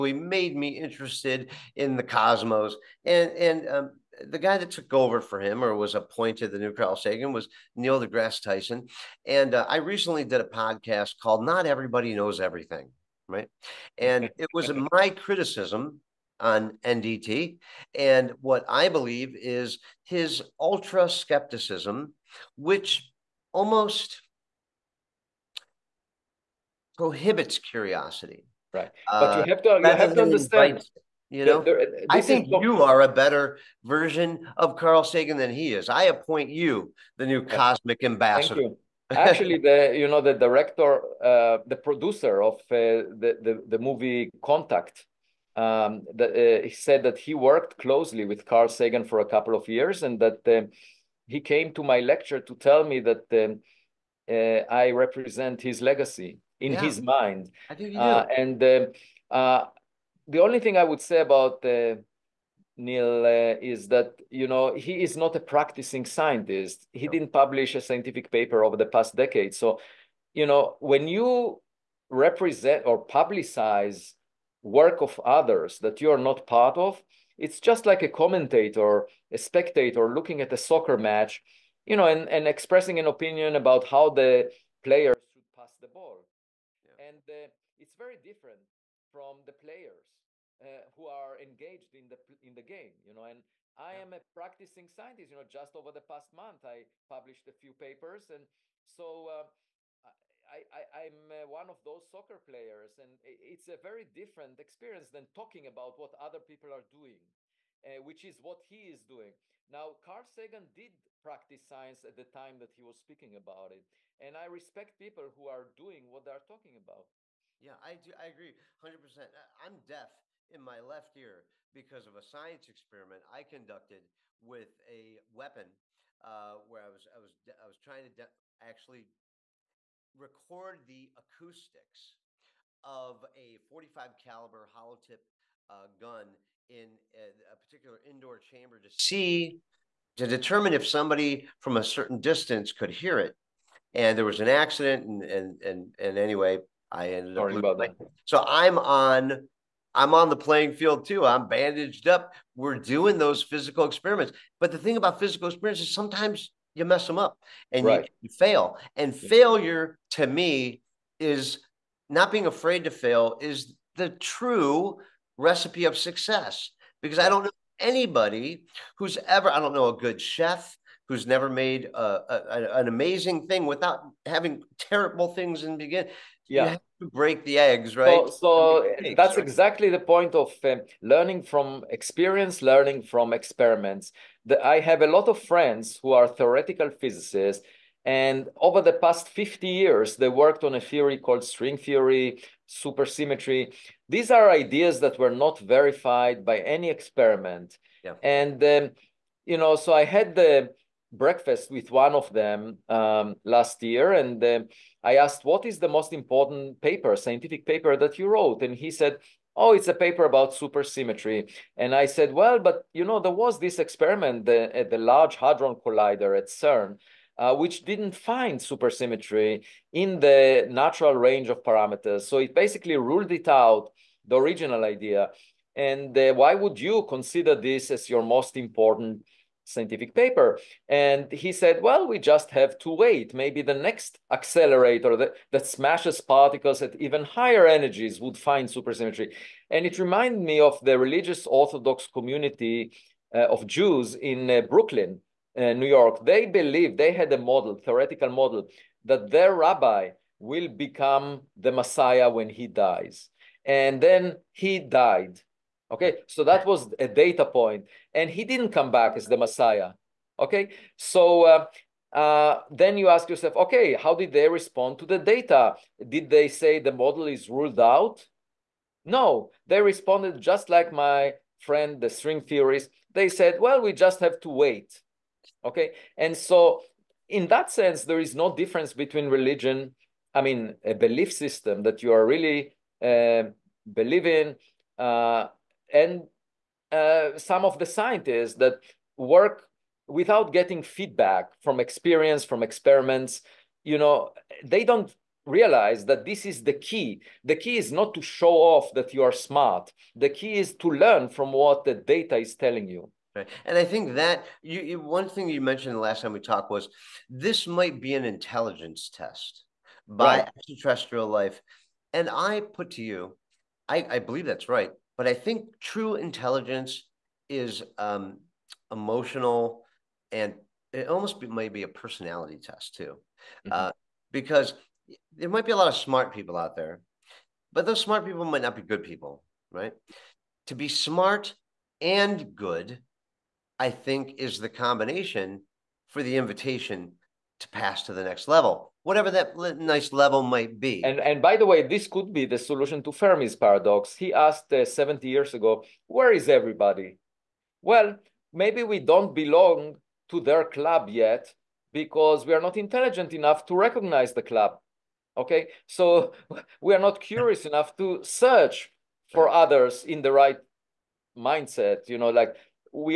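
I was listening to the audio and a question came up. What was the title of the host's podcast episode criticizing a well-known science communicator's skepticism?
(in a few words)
Not Everybody Knows Everything.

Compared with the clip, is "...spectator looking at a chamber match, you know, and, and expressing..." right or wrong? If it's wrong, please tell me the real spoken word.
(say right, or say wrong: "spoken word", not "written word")
wrong: "soccer", not "chamber".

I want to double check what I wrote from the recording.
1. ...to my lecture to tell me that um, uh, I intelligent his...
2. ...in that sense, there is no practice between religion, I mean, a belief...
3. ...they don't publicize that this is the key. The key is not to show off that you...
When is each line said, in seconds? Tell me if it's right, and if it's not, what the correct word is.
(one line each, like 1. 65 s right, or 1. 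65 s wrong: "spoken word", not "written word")
1. 51 s wrong: "represent", not "intelligent"
2. 277 s wrong: "difference", not "practice"
3. 294 s wrong: "realize", not "publicize".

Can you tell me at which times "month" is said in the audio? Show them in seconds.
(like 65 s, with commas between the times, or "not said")
96 s.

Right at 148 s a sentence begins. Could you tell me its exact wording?
so i'm on I'm on the playing field too.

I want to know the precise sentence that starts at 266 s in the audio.
Did they say the model is ruled out?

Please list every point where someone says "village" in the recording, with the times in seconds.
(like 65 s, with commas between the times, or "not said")
not said.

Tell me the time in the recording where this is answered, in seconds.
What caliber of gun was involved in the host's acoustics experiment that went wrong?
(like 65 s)
133 s.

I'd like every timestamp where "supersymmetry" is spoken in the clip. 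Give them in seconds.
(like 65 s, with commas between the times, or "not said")
192 s, 210 s, 218 s, 238 s.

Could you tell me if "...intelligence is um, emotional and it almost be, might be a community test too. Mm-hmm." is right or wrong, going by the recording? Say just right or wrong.
wrong.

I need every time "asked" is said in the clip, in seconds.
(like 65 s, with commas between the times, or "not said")
205 s, 344 s.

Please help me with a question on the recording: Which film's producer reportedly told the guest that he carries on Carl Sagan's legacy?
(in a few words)
Contact.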